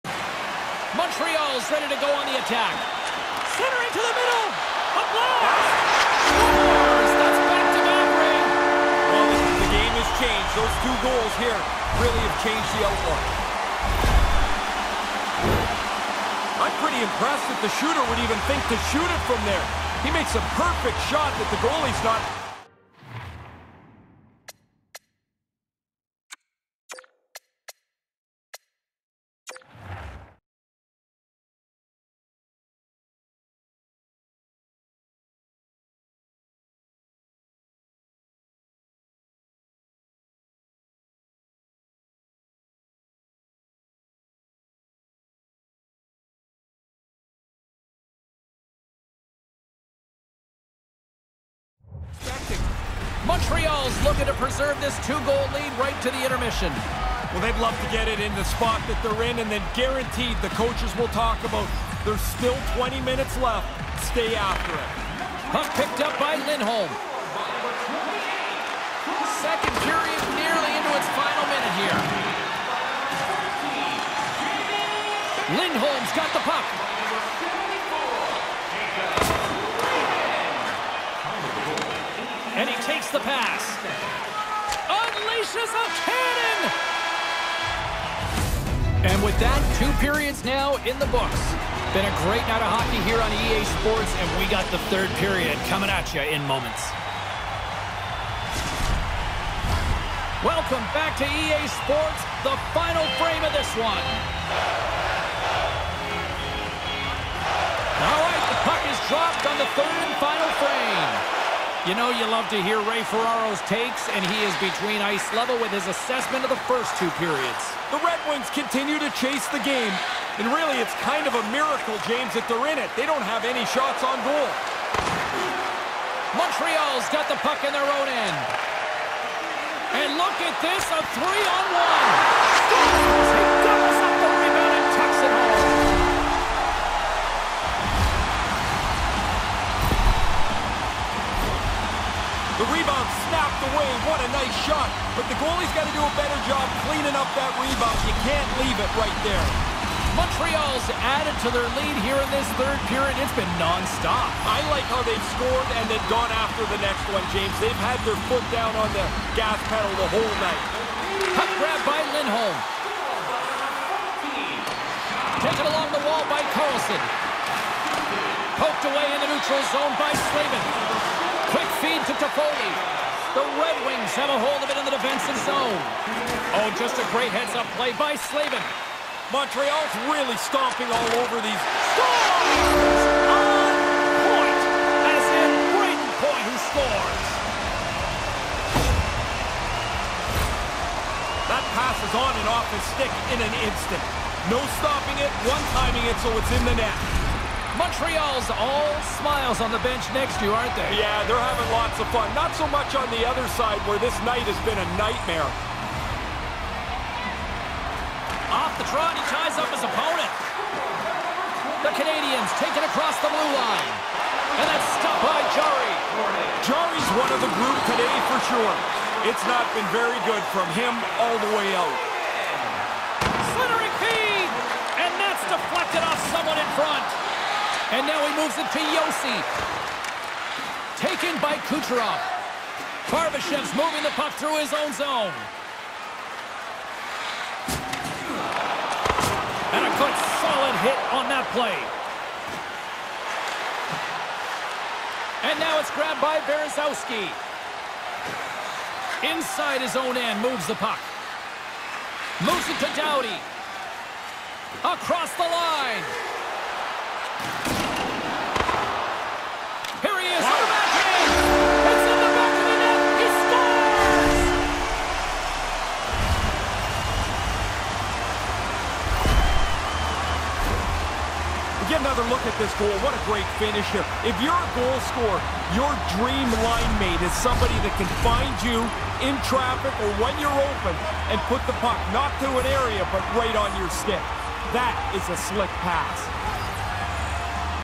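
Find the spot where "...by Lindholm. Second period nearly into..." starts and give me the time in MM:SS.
01:06.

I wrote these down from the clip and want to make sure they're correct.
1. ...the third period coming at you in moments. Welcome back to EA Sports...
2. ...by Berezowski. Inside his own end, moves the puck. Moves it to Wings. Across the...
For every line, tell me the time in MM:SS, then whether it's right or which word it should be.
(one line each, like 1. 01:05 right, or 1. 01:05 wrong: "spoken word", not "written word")
1. 01:34 right
2. 04:06 wrong: "Dowdy", not "Wings".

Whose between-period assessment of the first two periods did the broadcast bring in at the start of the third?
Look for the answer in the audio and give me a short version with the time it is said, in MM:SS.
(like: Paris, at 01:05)
Ray Ferraro, at 01:52.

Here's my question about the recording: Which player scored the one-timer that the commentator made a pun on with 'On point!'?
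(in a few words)
Brayden Point.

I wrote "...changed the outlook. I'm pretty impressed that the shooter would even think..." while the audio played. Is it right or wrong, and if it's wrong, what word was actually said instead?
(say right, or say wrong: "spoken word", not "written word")
right.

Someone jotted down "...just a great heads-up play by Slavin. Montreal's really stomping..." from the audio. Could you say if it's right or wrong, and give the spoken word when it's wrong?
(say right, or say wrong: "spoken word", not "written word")
right.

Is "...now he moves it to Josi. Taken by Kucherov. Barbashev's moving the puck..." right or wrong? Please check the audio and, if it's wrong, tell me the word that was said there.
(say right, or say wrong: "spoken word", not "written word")
right.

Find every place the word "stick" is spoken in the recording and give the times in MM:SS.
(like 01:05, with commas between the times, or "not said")
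03:12, 04:43.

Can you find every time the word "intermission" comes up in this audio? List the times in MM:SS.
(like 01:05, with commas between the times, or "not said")
00:56.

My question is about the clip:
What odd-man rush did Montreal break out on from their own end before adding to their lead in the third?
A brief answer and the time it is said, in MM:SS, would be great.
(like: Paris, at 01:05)
three-on-one, at 02:10.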